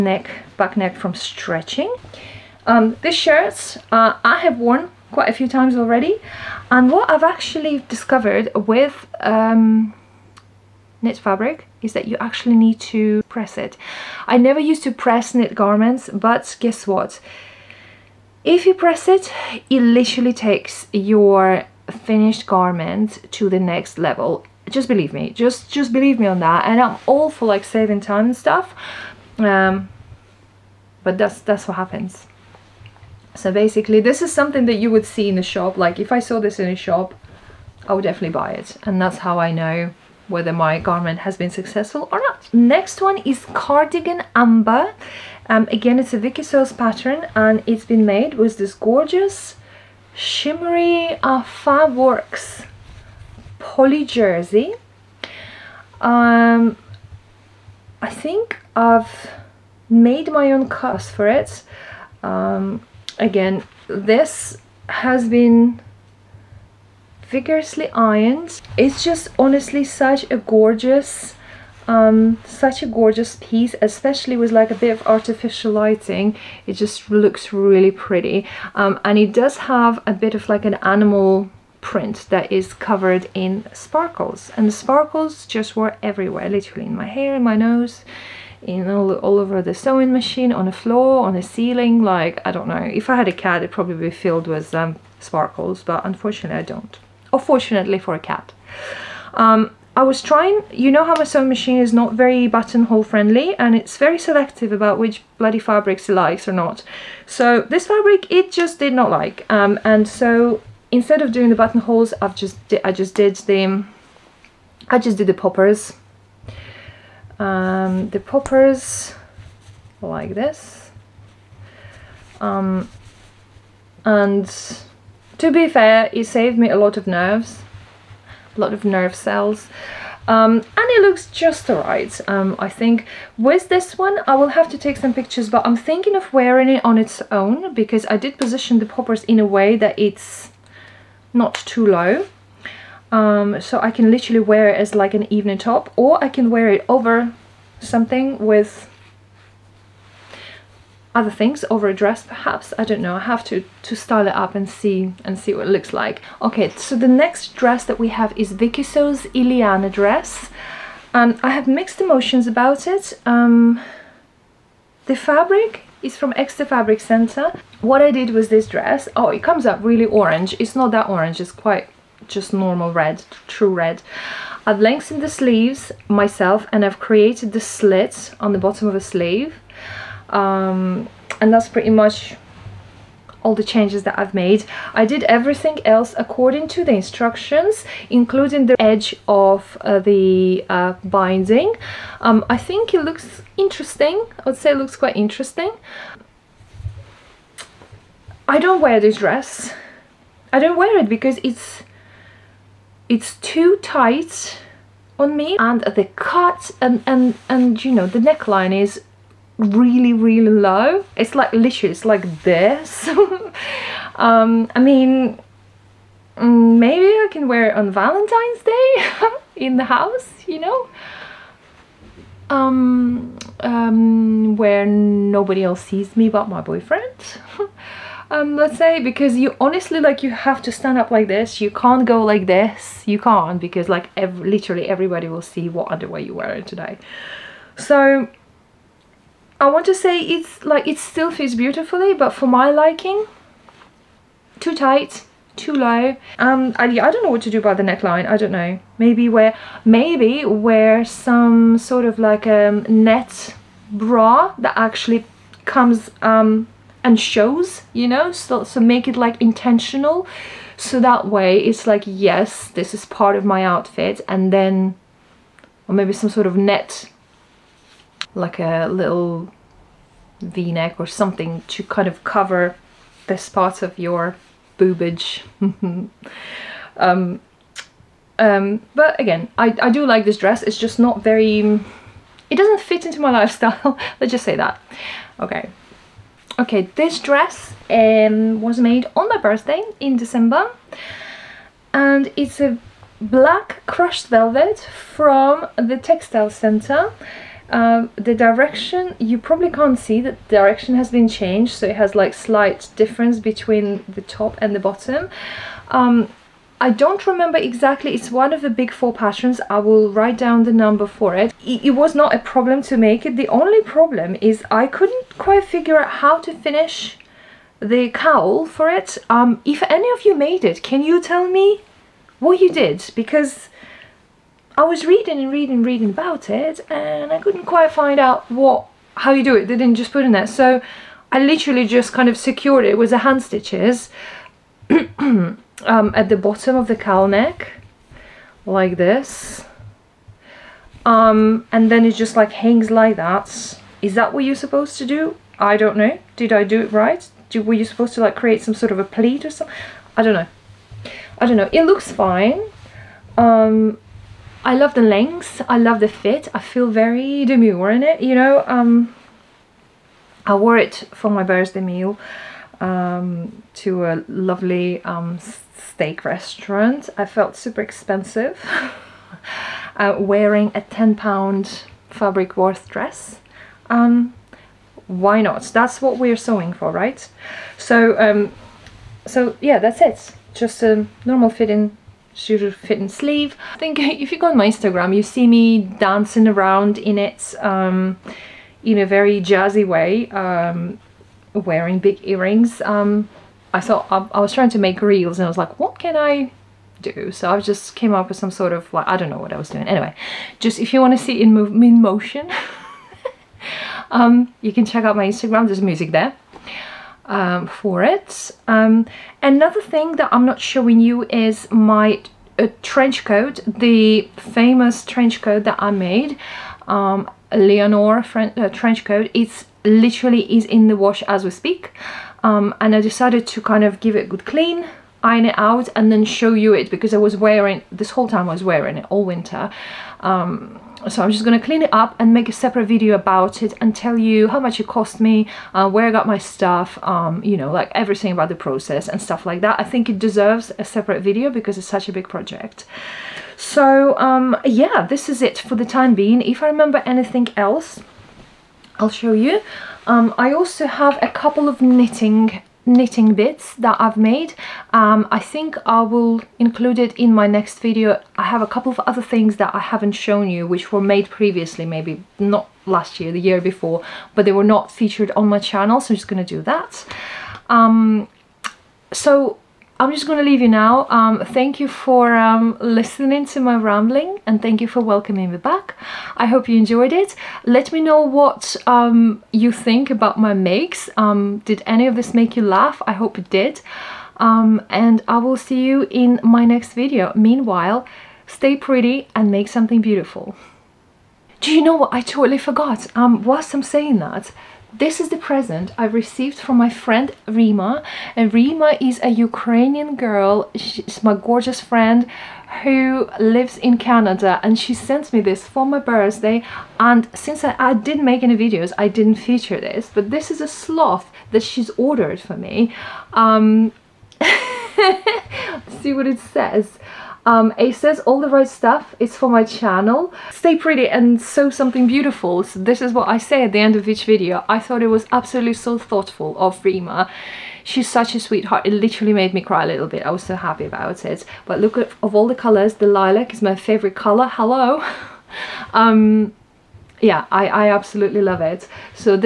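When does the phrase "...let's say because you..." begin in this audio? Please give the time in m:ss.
3:48.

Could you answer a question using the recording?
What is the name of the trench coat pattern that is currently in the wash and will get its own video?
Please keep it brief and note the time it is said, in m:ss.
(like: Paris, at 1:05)
Leonore, at 6:57.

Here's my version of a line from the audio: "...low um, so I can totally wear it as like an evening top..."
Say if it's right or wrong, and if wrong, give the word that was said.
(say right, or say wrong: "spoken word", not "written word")
wrong: "literally", not "totally".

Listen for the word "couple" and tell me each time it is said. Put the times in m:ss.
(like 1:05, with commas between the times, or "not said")
7:31, 7:38.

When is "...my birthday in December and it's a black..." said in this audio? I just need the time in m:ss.
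4:49.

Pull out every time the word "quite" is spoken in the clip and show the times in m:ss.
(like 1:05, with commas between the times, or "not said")
0:05, 2:51, 3:14, 5:15, 5:27.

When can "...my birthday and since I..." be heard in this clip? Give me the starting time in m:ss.
8:25.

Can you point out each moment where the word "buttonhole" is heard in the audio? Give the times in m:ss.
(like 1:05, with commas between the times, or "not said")
1:42, 1:51.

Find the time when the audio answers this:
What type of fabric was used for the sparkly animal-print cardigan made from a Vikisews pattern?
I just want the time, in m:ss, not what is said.
0:53.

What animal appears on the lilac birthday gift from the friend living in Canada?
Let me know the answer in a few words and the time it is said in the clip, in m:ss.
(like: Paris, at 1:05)
Sloth, at 8:30.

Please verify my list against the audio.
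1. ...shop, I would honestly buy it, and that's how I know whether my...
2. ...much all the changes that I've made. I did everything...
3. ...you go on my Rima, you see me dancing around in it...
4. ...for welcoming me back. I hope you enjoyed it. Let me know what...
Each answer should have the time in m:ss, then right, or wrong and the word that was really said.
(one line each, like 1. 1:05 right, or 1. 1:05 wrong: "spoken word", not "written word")
1. 0:36 wrong: "definitely", not "honestly"
2. 3:01 right
3. 6:24 wrong: "Instagram", not "Rima"
4. 7:54 right.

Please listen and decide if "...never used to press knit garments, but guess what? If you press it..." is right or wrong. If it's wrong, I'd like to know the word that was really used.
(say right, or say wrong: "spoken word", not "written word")
right.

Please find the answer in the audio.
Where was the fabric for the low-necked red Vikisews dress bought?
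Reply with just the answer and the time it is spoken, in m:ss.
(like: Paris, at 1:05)
Exeter Fabric Center, at 2:46.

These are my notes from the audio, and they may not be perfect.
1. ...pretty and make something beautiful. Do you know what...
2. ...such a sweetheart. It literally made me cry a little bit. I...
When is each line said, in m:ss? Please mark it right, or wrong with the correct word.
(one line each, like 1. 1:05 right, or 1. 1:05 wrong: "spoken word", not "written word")
1. 8:08 right
2. 8:48 right.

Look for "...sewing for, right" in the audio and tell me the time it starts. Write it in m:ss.
6:16.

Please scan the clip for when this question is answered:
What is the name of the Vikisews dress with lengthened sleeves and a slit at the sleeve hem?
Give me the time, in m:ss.
2:39.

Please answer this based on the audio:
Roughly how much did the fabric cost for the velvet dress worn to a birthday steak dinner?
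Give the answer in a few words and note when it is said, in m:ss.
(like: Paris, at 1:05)
10 pounds, at 6:10.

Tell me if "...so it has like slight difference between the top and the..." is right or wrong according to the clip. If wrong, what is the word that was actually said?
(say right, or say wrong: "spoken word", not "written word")
right.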